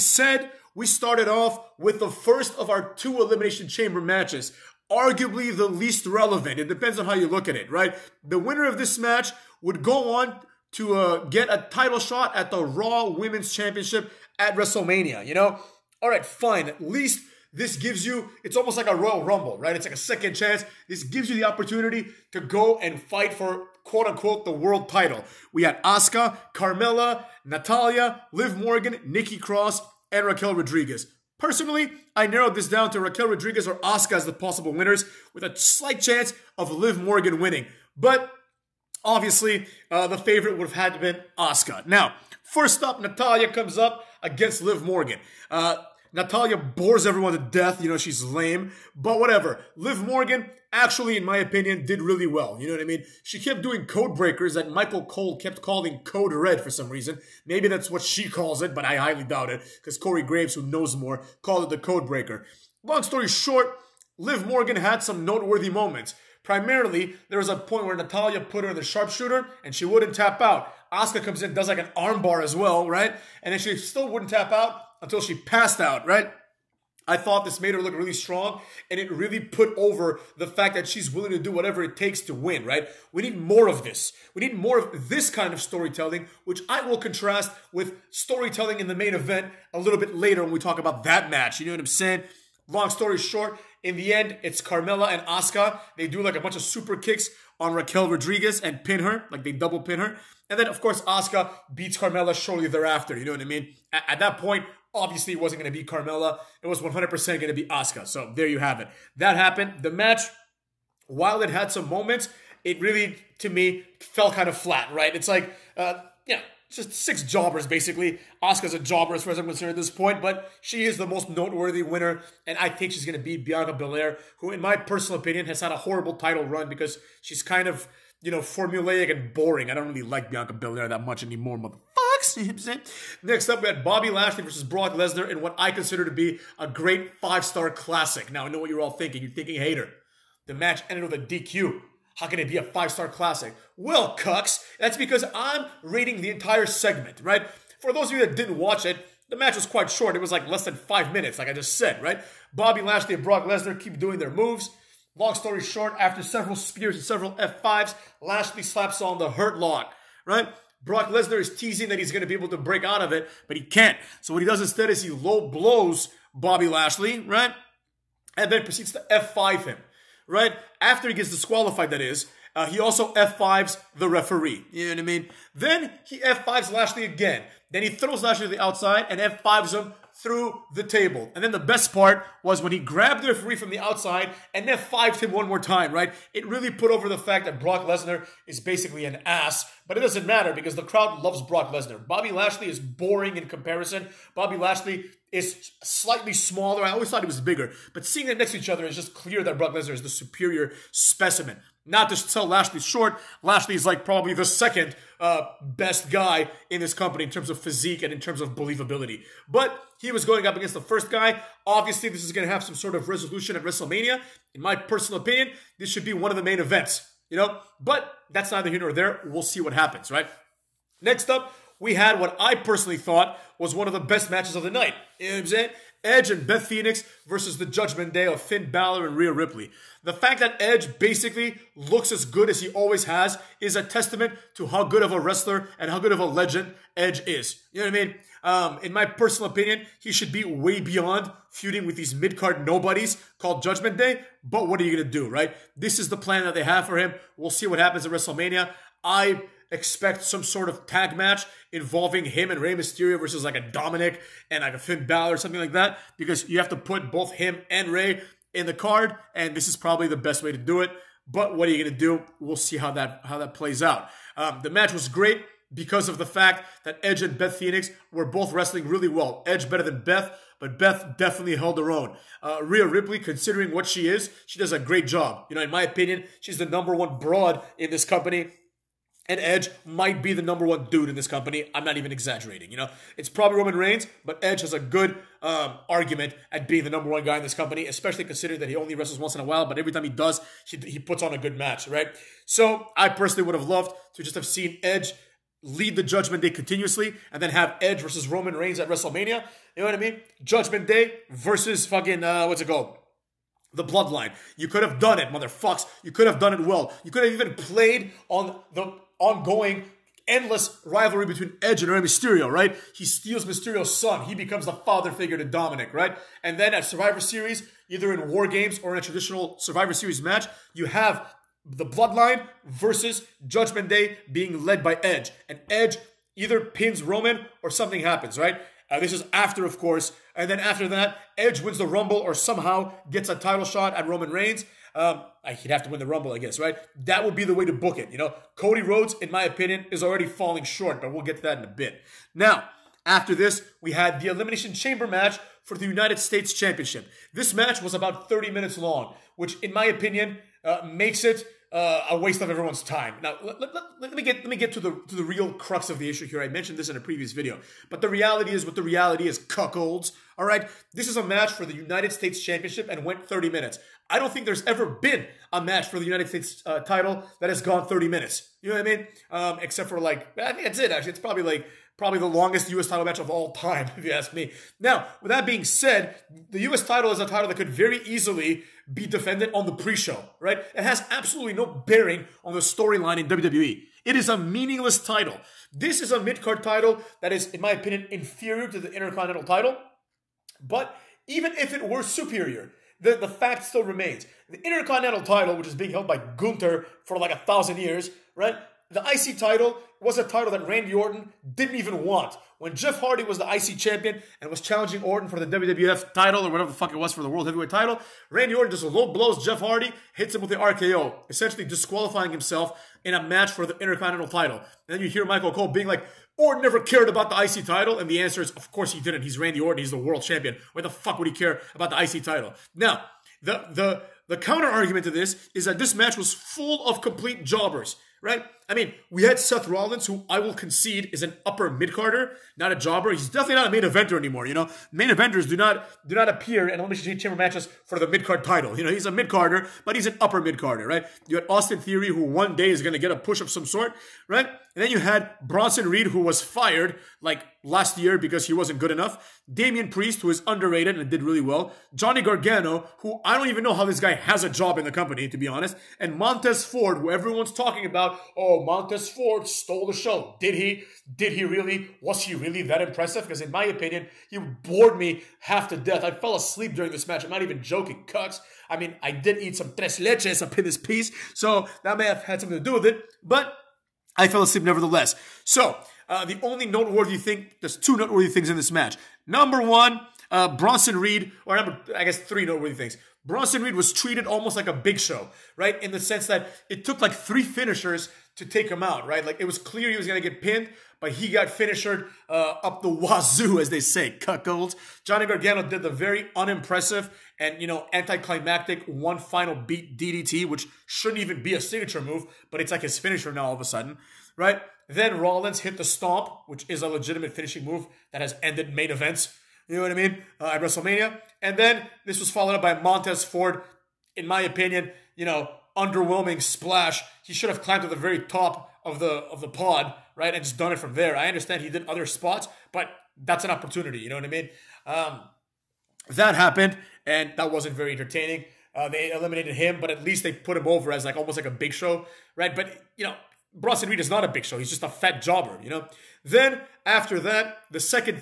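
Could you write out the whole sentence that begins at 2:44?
So what he does instead is he low blows Bobby Lashley, right?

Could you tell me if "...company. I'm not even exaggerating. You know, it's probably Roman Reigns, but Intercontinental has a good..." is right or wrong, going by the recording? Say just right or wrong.
wrong.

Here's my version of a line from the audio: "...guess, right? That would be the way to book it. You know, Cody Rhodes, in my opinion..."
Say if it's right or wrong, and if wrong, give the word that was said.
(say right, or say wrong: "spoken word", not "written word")
right.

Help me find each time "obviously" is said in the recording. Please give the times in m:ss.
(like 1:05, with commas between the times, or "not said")
0:39, 1:44, 3:31.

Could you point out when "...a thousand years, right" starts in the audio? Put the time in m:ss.
6:37.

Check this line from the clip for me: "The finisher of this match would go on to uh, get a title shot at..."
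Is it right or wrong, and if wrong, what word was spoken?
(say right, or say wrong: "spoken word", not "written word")
wrong: "winner", not "finisher".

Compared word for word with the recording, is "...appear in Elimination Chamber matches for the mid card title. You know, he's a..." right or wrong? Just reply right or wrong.
right.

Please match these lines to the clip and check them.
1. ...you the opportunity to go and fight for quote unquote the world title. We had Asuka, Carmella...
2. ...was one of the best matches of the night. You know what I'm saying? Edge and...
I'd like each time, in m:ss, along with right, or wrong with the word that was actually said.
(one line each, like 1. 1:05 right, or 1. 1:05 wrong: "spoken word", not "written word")
1. 0:21 right
2. 3:43 right.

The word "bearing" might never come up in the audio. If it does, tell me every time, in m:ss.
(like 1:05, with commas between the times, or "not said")
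6:21.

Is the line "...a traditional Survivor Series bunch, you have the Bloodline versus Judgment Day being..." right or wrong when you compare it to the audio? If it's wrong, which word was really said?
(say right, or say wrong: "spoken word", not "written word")
wrong: "match", not "bunch".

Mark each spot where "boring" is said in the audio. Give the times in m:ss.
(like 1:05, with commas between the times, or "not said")
2:09, 3:12.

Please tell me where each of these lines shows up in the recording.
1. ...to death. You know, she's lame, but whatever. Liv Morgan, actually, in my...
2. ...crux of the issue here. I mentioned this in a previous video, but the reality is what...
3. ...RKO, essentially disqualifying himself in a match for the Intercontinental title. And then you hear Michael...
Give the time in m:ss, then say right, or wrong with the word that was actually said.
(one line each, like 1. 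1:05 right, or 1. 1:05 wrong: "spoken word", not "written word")
1. 0:47 right
2. 5:55 right
3. 6:50 right.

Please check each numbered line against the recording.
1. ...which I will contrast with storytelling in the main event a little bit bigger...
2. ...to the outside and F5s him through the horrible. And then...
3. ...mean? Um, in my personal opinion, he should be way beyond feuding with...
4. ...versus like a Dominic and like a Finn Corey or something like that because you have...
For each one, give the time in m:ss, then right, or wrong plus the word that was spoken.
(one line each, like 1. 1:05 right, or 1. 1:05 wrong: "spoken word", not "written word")
1. 1:26 wrong: "later", not "bigger"
2. 2:58 wrong: "table", not "horrible"
3. 3:58 right
4. 4:13 wrong: "Balor", not "Corey".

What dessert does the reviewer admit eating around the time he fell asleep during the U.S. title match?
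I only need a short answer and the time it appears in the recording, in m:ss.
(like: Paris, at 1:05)
tres leches, at 7:49.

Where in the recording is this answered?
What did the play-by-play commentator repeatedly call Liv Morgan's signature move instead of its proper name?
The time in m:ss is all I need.
0:55.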